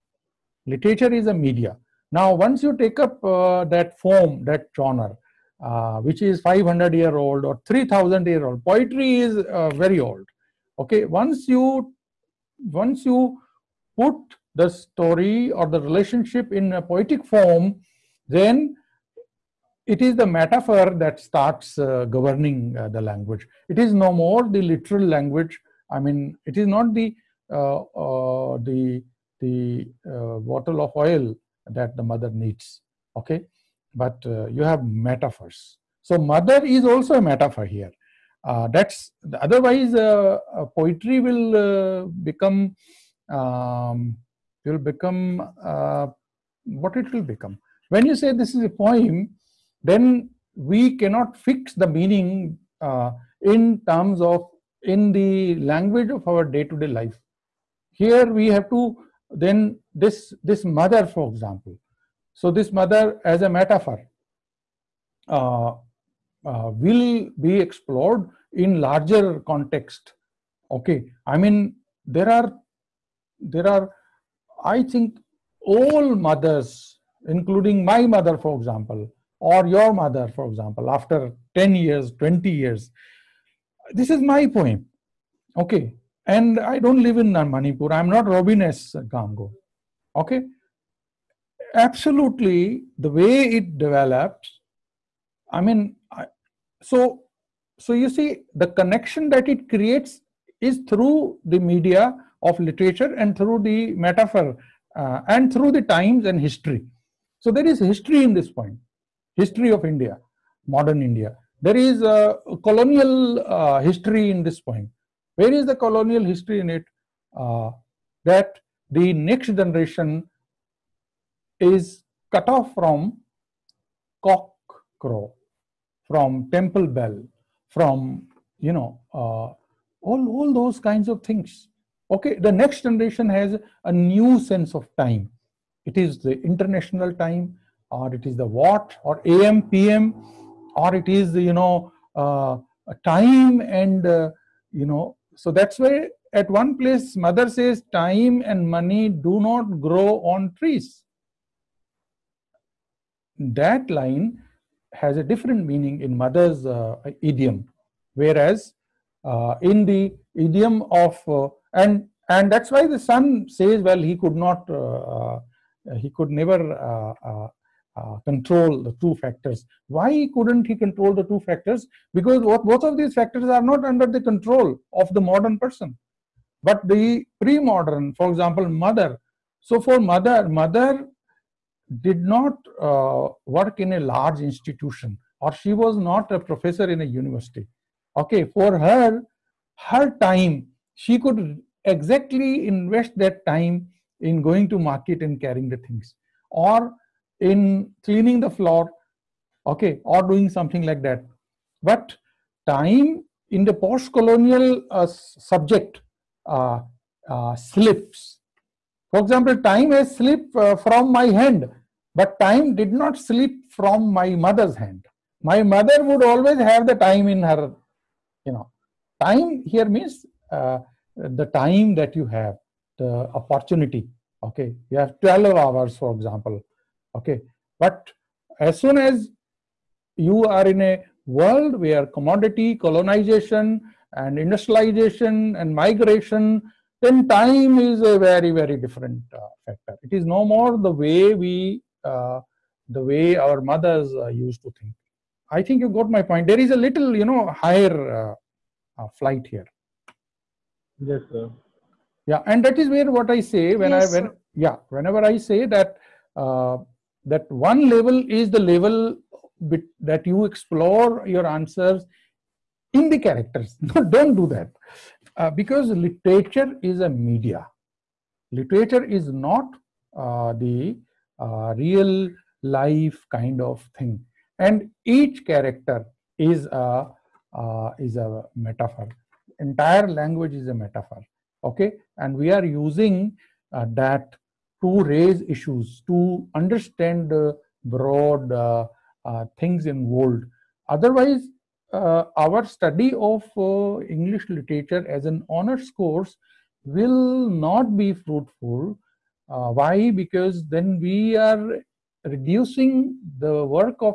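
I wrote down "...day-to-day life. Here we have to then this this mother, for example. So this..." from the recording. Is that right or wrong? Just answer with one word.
right.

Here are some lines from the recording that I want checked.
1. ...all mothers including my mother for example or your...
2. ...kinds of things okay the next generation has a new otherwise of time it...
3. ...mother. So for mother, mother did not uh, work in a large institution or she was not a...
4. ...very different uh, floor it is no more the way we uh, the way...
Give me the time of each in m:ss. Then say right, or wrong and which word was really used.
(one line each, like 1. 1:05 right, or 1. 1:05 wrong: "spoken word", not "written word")
1. 1:15 right
2. 2:10 wrong: "sense", not "otherwise"
3. 2:58 right
4. 3:58 wrong: "factor", not "floor".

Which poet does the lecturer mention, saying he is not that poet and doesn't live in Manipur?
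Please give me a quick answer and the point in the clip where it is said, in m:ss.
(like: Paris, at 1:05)
Robin S Ngangom, at 1:28.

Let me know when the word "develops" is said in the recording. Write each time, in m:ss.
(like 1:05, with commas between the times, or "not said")
1:33.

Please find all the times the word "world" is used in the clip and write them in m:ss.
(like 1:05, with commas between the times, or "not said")
3:51, 4:50.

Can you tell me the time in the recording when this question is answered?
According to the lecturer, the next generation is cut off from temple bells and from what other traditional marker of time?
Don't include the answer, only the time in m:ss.
2:04.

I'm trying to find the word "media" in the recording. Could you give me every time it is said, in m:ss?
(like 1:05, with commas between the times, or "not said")
0:01, 1:41, 4:27.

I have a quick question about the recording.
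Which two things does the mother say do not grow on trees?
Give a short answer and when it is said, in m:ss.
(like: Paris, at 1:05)
time and money, at 2:27.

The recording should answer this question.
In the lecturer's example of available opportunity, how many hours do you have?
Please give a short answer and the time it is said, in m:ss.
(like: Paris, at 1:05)
12, at 3:45.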